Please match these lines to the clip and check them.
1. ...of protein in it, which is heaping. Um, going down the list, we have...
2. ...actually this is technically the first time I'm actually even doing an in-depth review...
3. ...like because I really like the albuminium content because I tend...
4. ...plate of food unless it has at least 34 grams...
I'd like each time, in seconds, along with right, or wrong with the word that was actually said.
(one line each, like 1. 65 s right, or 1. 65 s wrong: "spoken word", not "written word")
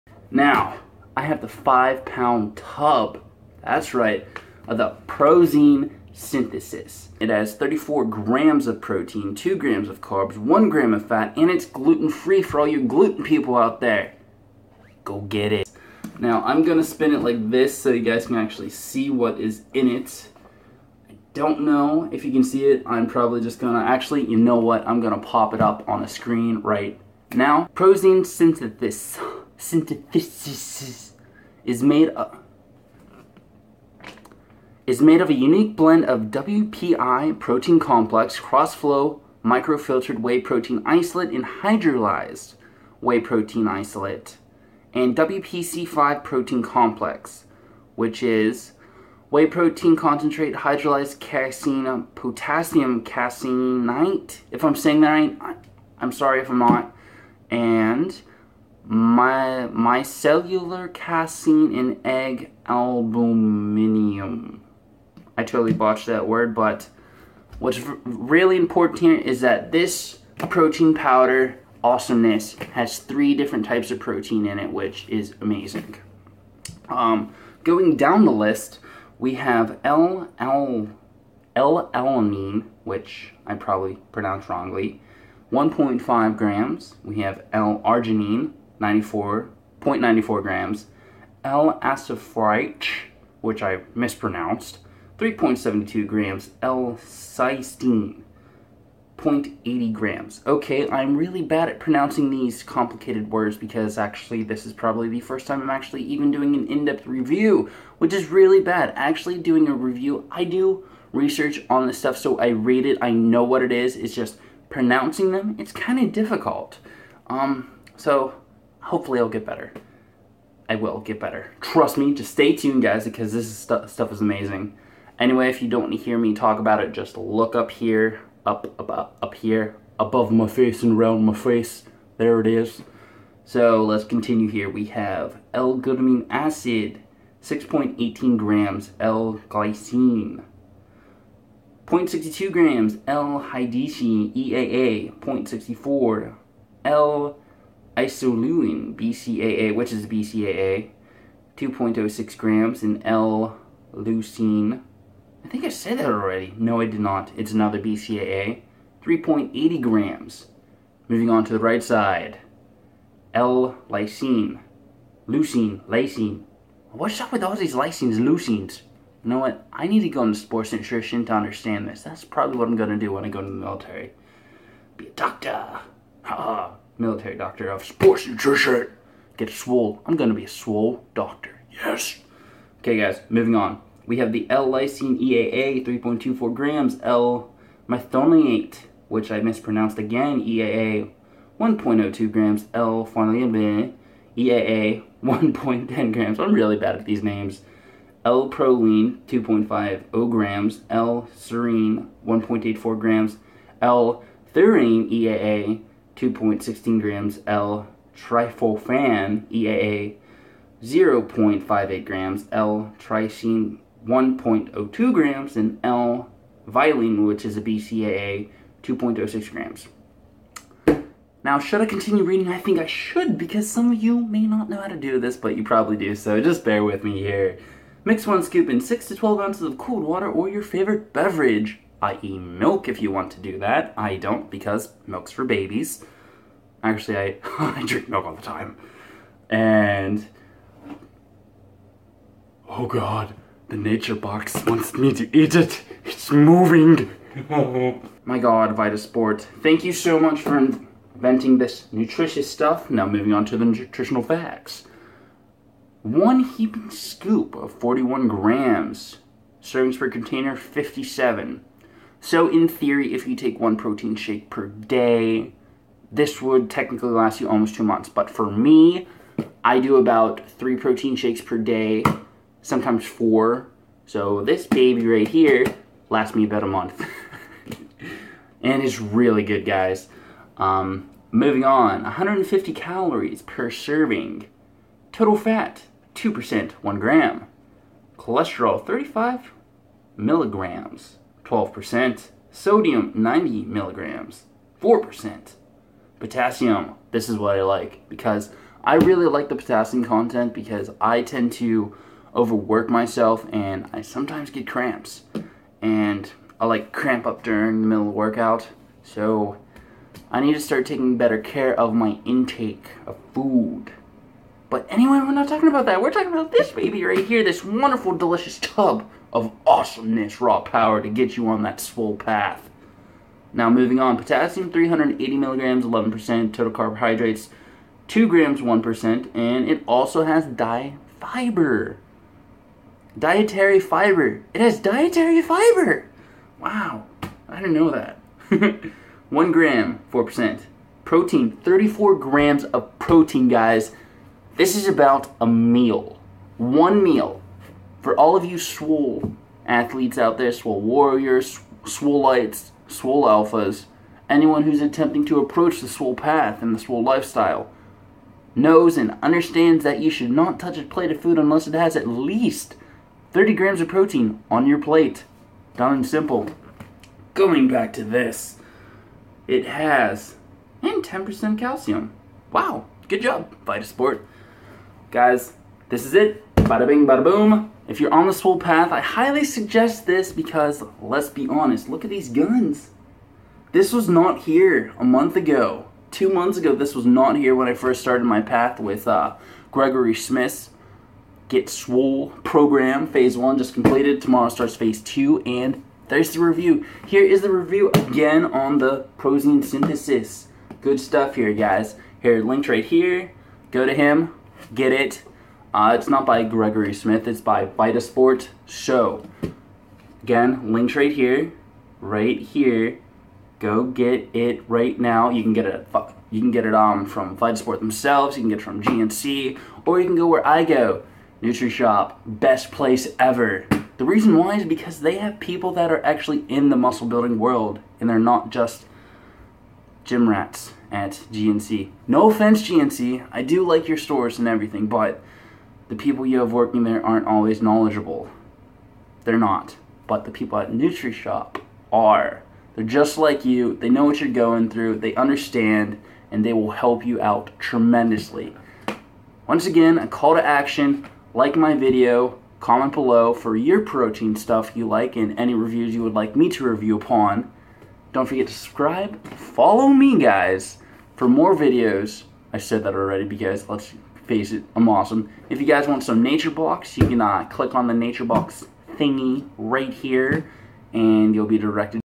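1. 73 s wrong: "amazing", not "heaping"
2. 103 s wrong: "probably", not "technically"
3. 297 s wrong: "potassium", not "albuminium"
4. 360 s wrong: "30", not "34".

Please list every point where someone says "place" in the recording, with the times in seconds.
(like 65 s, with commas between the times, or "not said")
422 s.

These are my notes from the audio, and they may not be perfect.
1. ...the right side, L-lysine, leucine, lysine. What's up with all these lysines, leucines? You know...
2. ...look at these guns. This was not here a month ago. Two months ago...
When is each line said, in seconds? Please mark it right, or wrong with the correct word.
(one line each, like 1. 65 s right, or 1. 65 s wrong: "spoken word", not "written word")
1. 161 s right
2. 381 s right.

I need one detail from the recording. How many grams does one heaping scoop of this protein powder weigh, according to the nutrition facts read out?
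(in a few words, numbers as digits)
41 grams.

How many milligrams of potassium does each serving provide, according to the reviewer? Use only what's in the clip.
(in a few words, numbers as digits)
380 milligrams.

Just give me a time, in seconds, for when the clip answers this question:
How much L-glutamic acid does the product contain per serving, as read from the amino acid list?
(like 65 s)
137 s.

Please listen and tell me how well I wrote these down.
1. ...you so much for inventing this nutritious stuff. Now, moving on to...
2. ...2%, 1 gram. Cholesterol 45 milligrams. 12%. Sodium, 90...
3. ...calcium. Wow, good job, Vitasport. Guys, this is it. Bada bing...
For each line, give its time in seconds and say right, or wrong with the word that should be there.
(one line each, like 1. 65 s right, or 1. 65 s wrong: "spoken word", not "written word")
1. 249 s right
2. 286 s wrong: "35", not "45"
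3. 371 s right.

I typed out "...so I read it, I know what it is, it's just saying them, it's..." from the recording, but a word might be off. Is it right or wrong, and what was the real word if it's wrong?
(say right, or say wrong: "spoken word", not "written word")
wrong: "pronouncing", not "saying".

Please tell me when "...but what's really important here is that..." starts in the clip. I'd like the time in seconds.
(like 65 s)
66 s.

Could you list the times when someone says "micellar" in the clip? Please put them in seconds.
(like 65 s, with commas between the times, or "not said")
58 s.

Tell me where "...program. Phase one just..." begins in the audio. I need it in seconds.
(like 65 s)
392 s.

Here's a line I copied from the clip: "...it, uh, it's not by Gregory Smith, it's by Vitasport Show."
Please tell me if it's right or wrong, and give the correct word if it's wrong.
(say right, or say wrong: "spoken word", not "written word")
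right.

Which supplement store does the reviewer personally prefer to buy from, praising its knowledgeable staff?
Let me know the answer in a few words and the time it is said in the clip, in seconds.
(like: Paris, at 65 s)
NutriShop, at 421 s.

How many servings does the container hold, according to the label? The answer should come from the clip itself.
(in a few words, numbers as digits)
57.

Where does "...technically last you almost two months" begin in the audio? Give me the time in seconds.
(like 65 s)
266 s.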